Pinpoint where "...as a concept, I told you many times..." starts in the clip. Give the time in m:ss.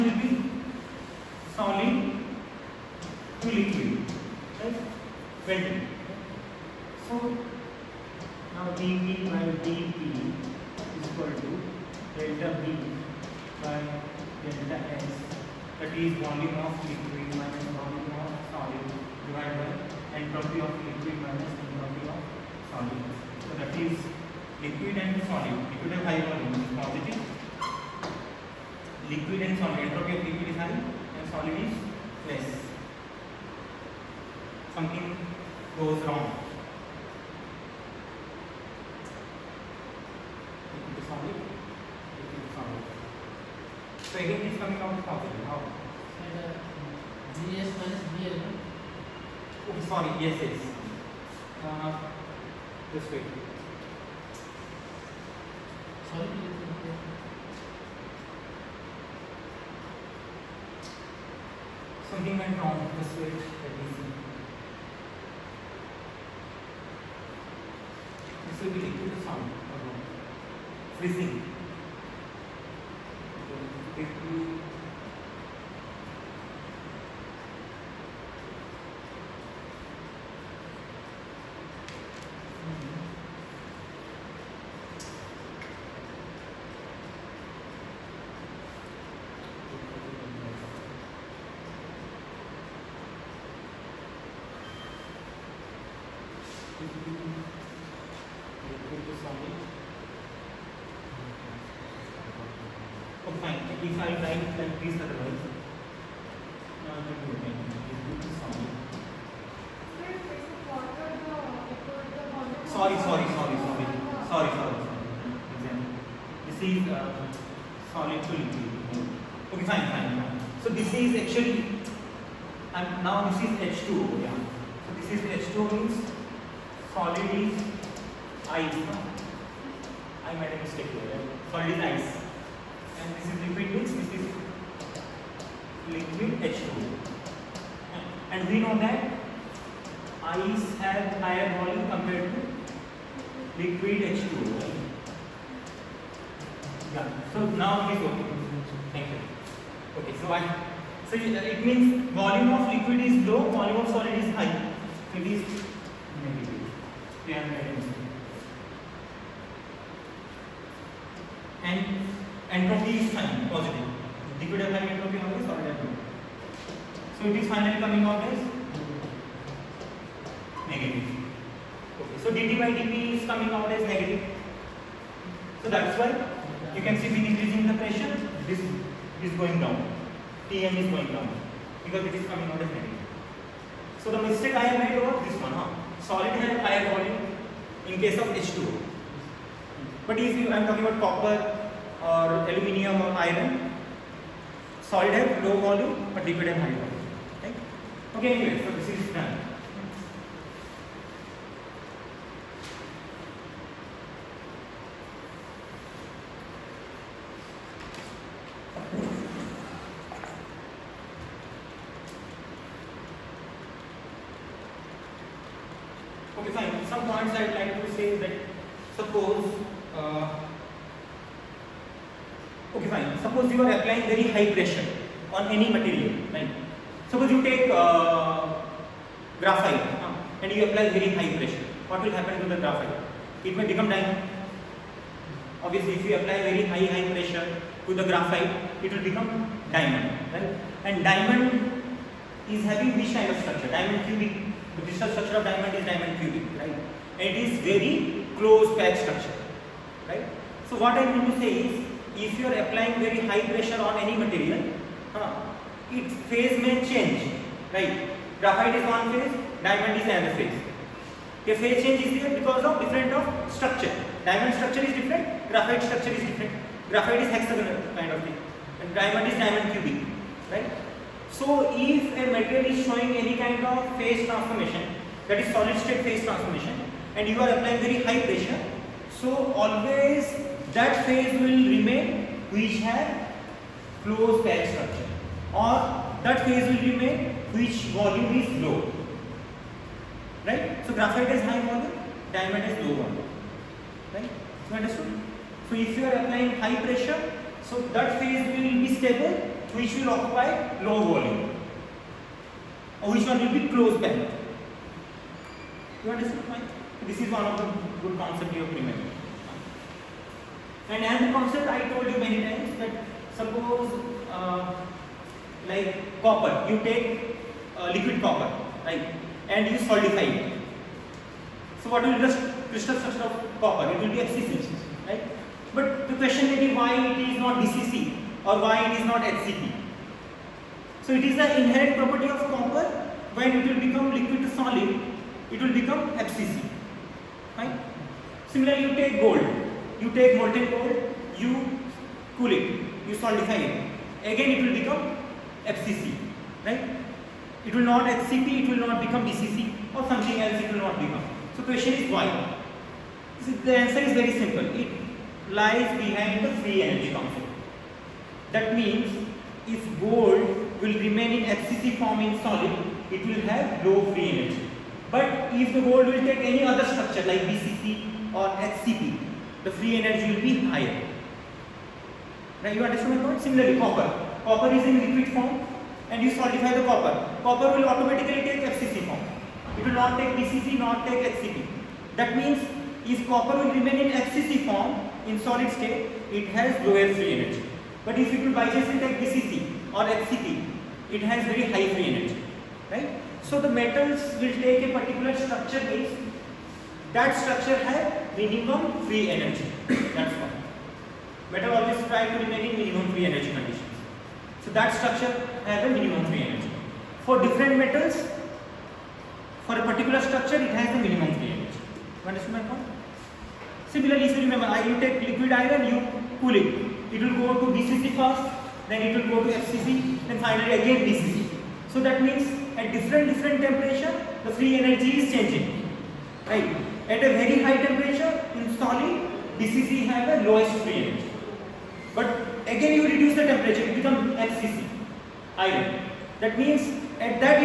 5:11.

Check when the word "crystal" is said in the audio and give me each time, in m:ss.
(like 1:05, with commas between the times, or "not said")
4:04, 5:22.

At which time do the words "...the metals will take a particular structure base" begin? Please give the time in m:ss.
6:33.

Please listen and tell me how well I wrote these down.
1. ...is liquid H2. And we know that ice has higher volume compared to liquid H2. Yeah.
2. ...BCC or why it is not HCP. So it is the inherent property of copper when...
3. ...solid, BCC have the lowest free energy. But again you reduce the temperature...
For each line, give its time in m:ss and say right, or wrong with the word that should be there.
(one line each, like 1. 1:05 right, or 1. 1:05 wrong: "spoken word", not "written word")
1. 2:14 right
2. 5:27 right
3. 7:08 right.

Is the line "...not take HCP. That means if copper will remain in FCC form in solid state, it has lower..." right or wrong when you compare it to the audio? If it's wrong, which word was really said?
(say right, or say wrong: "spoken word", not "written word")
right.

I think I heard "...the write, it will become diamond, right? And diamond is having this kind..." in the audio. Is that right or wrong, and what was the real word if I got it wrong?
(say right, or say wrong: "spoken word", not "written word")
wrong: "graphite", not "write".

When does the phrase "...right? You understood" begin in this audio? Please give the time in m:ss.
4:54.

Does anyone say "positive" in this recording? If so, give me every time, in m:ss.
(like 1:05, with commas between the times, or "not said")
0:26, 0:45, 2:43.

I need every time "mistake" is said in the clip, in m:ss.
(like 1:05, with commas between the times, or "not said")
2:10, 3:04.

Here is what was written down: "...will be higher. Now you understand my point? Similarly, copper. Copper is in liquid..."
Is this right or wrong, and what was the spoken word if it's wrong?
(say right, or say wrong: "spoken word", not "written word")
right.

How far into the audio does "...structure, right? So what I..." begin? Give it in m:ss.
4:09.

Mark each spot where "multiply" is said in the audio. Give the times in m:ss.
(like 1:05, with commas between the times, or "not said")
not said.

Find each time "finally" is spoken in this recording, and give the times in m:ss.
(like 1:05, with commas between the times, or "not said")
2:47, 7:00.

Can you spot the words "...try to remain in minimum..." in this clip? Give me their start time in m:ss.
6:42.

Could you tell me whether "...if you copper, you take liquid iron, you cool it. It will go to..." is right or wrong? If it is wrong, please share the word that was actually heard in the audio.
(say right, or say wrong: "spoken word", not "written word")
wrong: "remember", not "copper".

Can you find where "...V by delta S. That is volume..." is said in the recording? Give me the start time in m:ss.
0:12.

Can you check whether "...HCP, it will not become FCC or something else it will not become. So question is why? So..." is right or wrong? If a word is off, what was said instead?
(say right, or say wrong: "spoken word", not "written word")
wrong: "BCC", not "FCC".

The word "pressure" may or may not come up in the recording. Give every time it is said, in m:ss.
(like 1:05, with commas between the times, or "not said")
2:57, 3:57, 4:13, 4:38, 4:56.